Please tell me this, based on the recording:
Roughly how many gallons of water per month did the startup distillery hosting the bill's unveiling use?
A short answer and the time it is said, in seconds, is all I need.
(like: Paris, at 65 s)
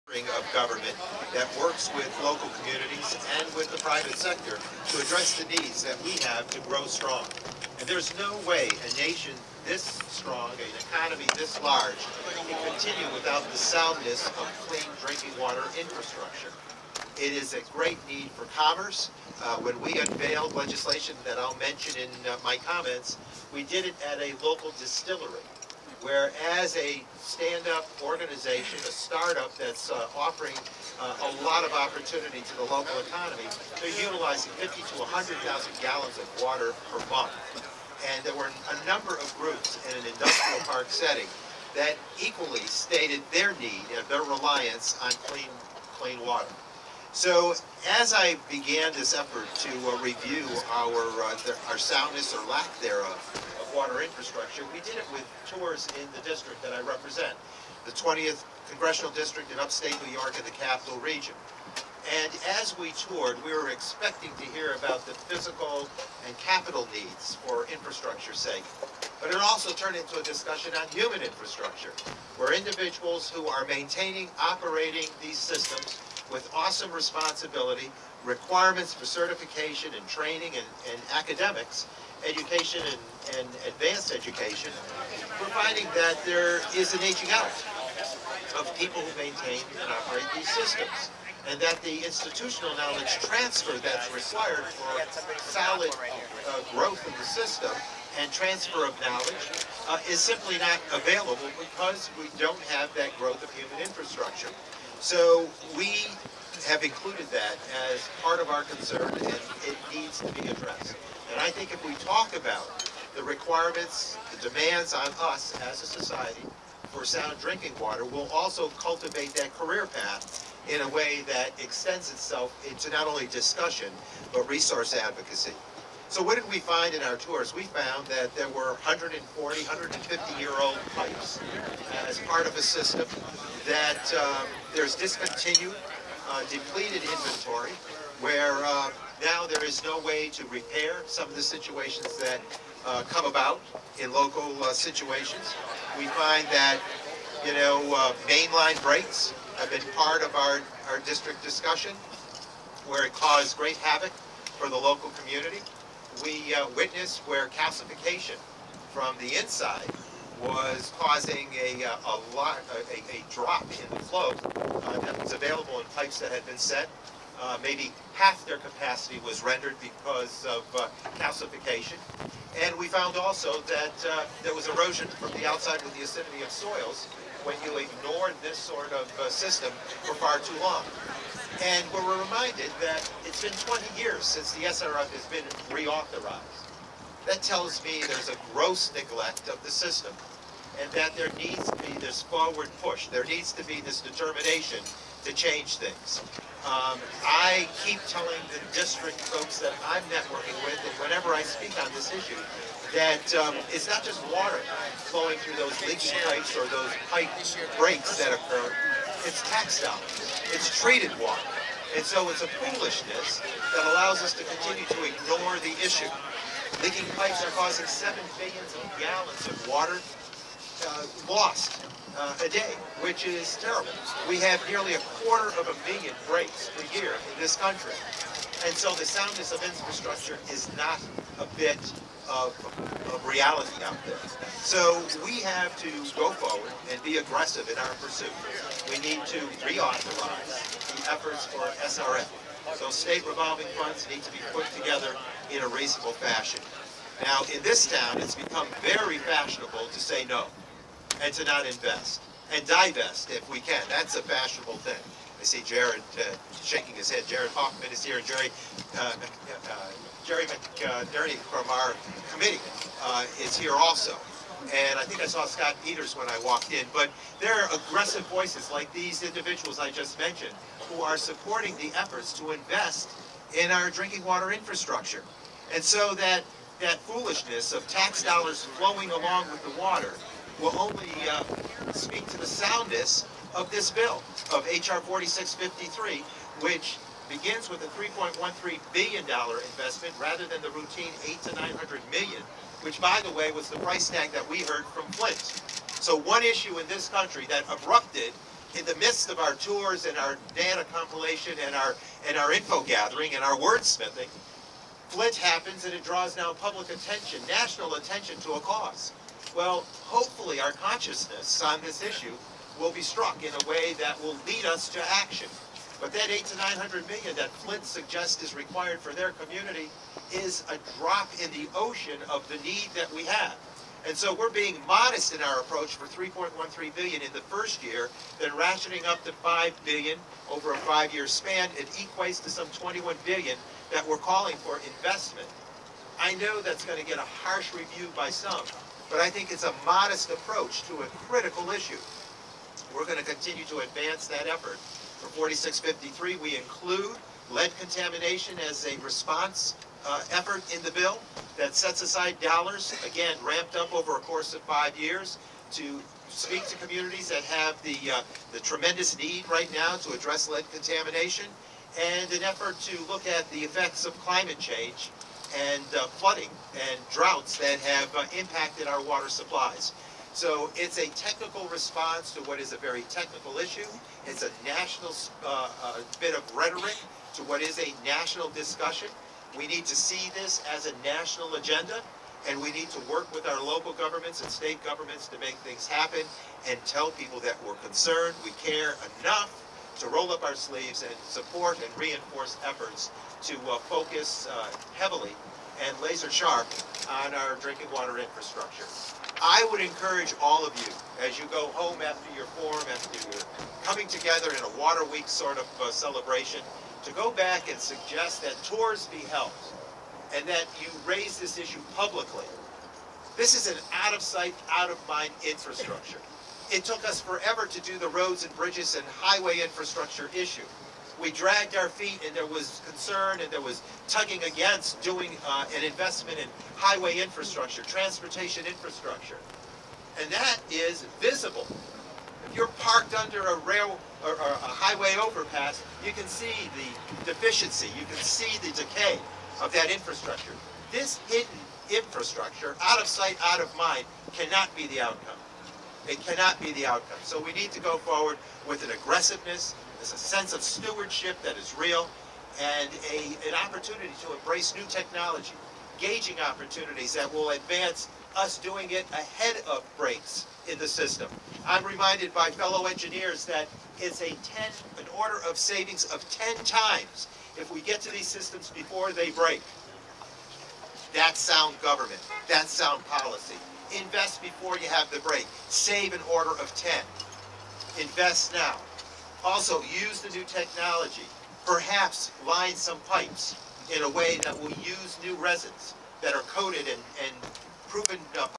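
50 to 100,000, at 34 s.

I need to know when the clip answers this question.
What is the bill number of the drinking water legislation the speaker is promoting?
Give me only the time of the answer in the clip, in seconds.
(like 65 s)
284 s.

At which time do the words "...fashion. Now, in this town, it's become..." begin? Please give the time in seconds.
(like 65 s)
246 s.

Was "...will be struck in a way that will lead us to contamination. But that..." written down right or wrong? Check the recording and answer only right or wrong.
wrong.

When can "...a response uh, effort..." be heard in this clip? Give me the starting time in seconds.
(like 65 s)
348 s.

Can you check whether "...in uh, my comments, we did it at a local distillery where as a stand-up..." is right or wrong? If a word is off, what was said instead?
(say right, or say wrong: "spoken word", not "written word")
right.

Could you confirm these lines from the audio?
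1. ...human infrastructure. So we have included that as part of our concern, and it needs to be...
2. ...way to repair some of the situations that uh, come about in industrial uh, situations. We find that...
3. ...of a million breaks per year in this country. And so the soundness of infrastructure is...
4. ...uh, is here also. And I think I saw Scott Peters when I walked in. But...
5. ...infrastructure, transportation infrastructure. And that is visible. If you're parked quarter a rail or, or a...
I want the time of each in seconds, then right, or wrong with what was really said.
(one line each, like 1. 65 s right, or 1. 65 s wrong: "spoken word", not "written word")
1. 103 s right
2. 139 s wrong: "local", not "industrial"
3. 225 s right
4. 263 s right
5. 427 s wrong: "under", not "quarter".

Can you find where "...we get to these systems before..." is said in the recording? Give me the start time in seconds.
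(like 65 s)
467 s.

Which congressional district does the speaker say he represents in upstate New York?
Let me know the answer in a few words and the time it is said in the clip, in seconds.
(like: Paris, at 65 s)
20th, at 57 s.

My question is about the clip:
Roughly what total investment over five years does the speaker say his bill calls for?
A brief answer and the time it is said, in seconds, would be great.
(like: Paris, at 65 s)
21 billion, at 332 s.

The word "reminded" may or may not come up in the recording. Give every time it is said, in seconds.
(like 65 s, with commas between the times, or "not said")
182 s, 461 s.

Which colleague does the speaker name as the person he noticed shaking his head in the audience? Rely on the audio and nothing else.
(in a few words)
Jared Huffman.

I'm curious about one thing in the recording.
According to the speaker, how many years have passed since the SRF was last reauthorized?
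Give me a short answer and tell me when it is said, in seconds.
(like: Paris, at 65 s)
20 years, at 183 s.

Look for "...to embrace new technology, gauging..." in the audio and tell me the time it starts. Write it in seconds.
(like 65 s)
454 s.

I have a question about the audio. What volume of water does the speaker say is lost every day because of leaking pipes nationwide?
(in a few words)
7 billion gallons.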